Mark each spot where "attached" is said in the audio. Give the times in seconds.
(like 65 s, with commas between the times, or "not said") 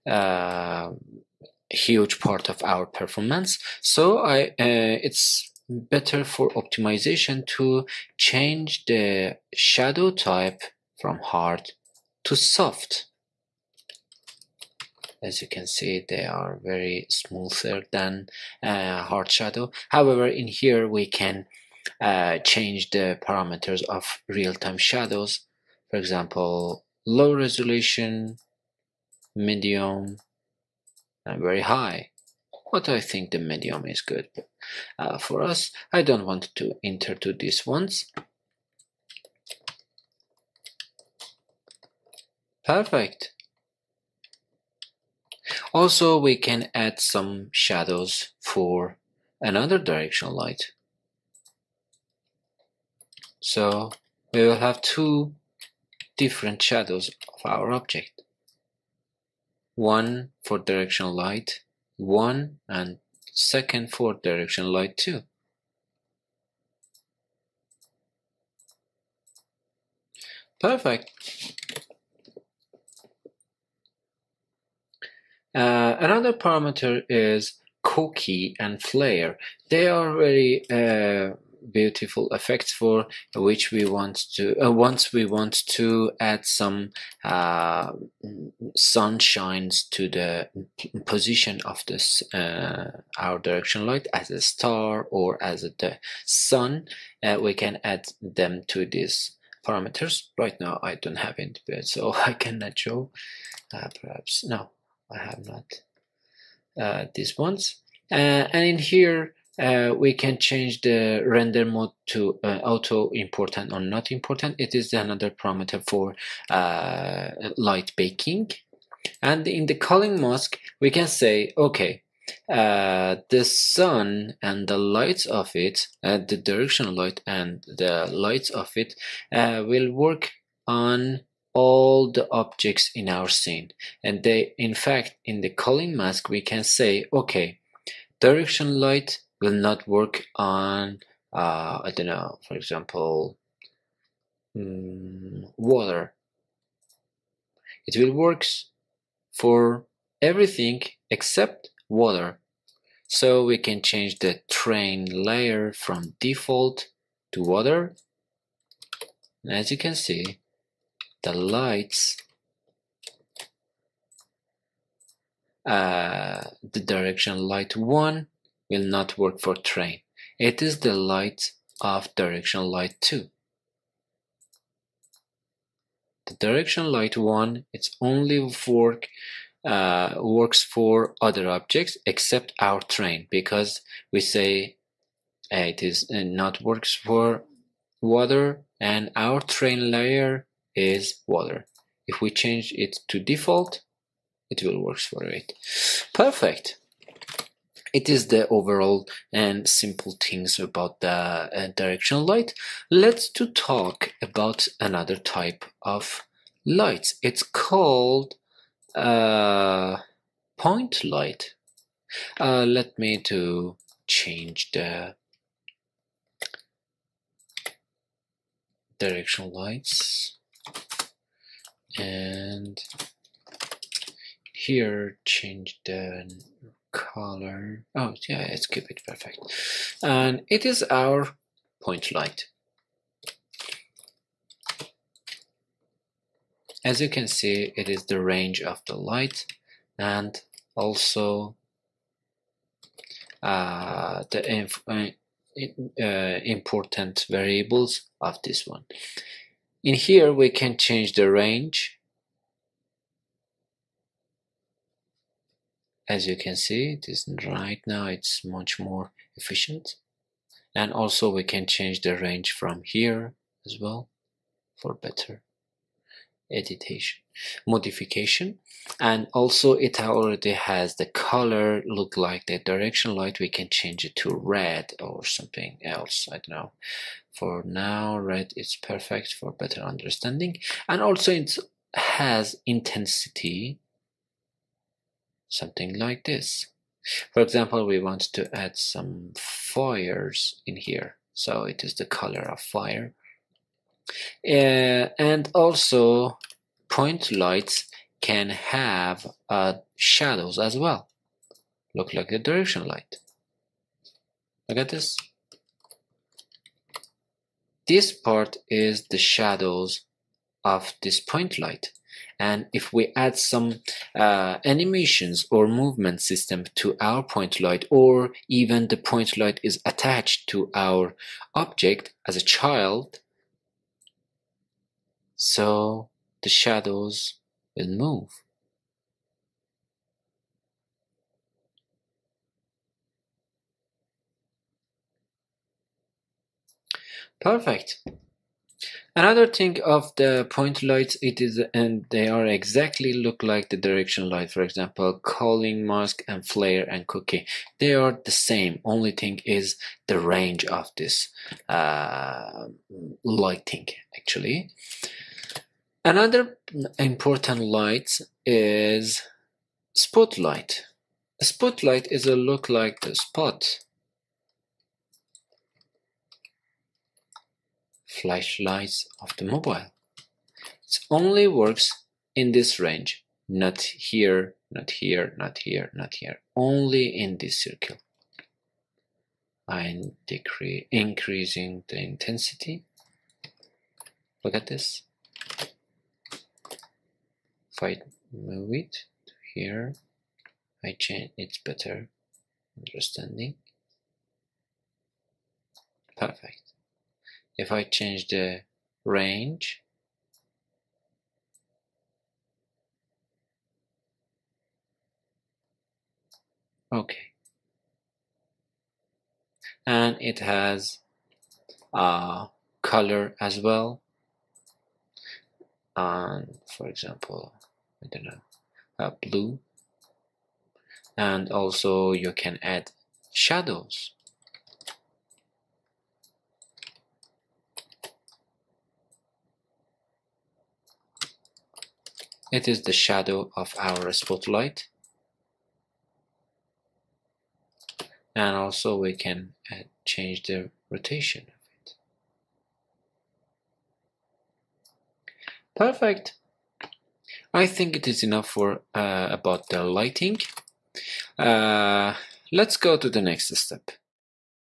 319 s.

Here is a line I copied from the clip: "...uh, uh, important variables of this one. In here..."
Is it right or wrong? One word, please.
right.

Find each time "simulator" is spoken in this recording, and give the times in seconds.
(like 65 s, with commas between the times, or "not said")
not said.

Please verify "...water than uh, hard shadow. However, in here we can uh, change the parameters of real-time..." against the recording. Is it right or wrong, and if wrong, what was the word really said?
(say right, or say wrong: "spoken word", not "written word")
wrong: "smoother", not "water".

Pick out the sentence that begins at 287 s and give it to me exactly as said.
For example, we want to add some fires in here.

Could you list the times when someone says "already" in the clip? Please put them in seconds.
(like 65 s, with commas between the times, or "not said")
269 s.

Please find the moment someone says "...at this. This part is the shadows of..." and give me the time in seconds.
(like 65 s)
304 s.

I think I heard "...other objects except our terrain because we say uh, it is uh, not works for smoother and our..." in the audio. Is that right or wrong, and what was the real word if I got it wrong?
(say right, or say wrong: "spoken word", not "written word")
wrong: "water", not "smoother".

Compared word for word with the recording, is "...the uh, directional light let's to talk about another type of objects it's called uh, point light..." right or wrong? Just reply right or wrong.
wrong.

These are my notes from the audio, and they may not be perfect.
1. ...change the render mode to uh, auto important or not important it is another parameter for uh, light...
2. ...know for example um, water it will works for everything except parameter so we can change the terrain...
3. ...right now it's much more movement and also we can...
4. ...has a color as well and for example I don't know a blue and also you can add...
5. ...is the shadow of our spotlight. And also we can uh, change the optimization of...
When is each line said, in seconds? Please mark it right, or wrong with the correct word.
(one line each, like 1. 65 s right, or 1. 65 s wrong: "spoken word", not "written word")
1. 110 s right
2. 142 s wrong: "water", not "parameter"
3. 257 s wrong: "efficient", not "movement"
4. 410 s right
5. 432 s wrong: "rotation", not "optimization".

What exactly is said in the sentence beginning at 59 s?
One for directional light 1 and second for directional light 2.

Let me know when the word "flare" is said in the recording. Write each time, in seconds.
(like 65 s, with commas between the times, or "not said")
78 s, 346 s.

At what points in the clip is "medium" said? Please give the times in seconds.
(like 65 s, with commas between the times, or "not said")
29 s, 33 s.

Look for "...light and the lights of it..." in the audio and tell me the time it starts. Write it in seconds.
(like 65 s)
126 s.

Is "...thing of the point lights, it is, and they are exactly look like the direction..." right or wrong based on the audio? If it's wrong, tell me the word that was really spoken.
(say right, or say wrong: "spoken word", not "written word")
right.